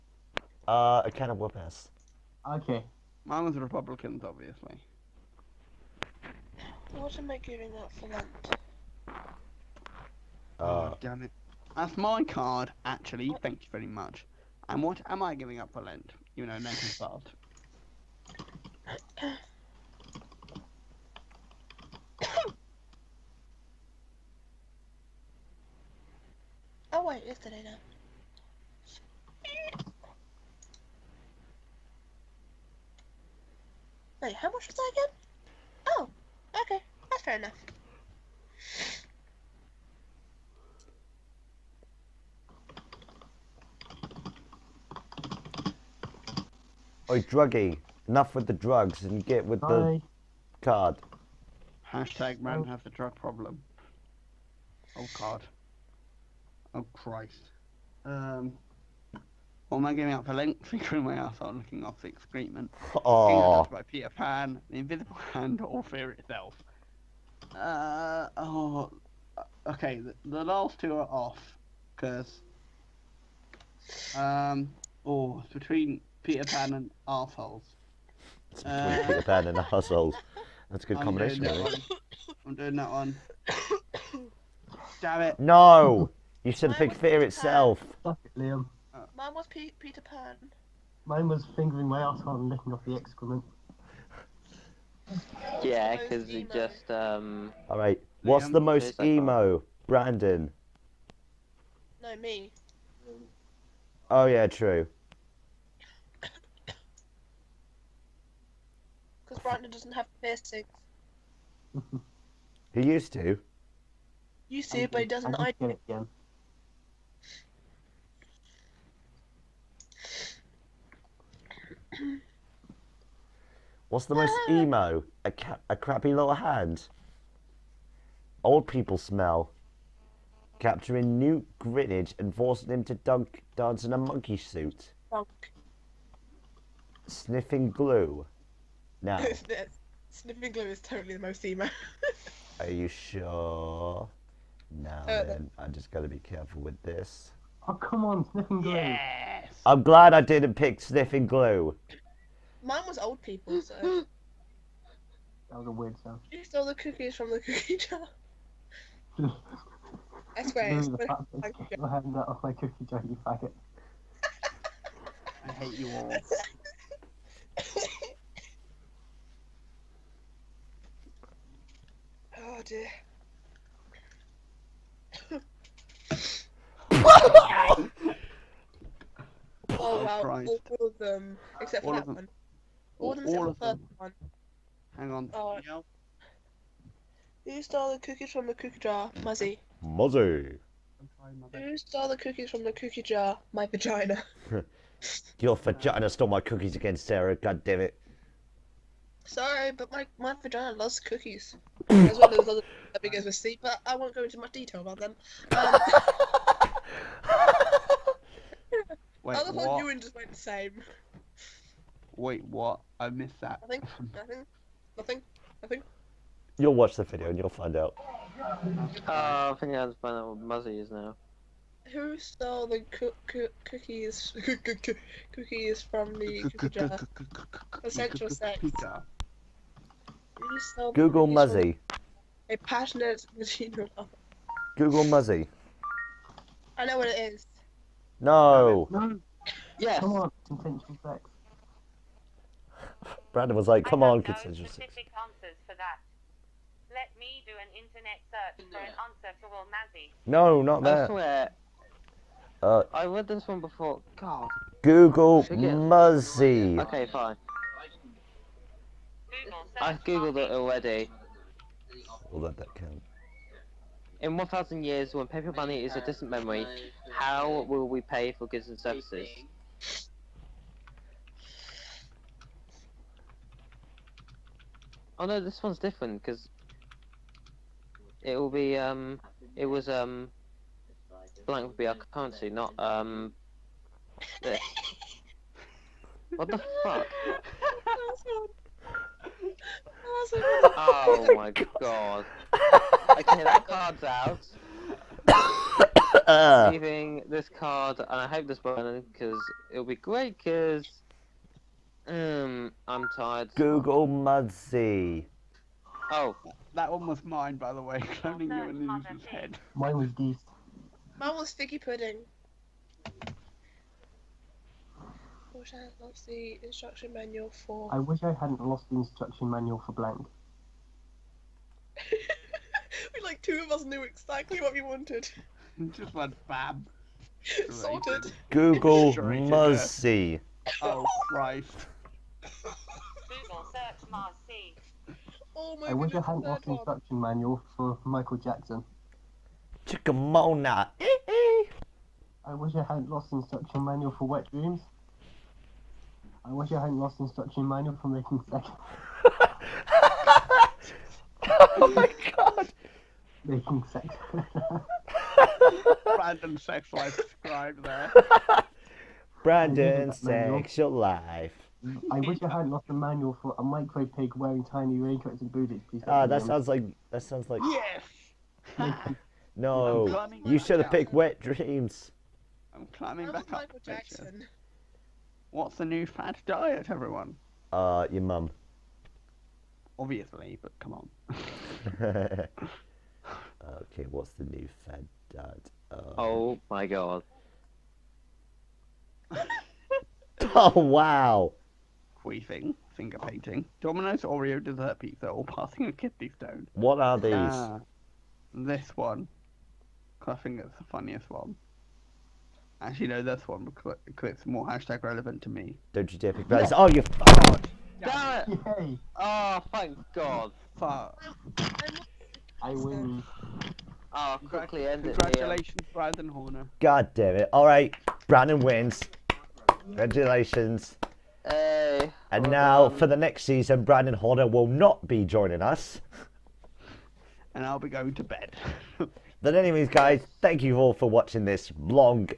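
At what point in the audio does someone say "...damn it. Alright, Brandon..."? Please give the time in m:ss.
6:57.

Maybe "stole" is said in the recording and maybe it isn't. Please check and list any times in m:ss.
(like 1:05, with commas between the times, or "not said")
2:36, 3:07, 3:11, 3:16, 3:42.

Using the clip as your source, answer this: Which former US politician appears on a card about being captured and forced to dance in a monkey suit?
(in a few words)
Newt Gingrich.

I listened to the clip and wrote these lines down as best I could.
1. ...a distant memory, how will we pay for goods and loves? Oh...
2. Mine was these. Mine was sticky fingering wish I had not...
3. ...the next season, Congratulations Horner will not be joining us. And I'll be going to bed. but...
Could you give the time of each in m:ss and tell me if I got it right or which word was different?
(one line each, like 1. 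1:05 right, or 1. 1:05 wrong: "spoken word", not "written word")
1. 4:25 wrong: "services", not "loves"
2. 5:09 wrong: "pudding", not "fingering"
3. 7:03 wrong: "Brandon", not "Congratulations".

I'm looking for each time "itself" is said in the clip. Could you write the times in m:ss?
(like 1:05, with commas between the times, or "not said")
1:06, 1:27.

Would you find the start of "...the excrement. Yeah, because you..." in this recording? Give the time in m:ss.
1:32.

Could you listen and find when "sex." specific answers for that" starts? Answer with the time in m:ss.
4:04.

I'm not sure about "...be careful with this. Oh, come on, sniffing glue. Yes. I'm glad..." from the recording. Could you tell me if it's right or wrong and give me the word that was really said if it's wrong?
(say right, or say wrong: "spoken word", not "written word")
right.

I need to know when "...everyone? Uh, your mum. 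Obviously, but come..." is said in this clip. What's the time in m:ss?
6:16.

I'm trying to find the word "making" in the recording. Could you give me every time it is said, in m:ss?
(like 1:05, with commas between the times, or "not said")
5:48, 5:53.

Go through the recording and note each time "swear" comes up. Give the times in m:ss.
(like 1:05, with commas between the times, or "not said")
2:40, 4:11.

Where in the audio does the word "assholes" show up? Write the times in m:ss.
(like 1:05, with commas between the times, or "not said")
1:19, 1:32.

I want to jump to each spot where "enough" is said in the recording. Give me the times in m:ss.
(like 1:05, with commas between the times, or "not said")
0:37, 0:48.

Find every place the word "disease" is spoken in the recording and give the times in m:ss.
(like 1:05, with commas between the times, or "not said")
not said.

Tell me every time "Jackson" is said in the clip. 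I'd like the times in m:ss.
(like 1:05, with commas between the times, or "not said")
5:38, 6:13.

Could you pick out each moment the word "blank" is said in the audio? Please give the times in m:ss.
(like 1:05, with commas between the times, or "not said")
4:41, 5:19.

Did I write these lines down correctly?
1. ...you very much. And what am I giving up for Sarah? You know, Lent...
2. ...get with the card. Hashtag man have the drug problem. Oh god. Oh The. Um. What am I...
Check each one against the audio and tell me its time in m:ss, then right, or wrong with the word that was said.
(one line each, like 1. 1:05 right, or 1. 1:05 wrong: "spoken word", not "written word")
1. 0:13 wrong: "Lent", not "Sarah"
2. 0:49 wrong: "Christ", not "The".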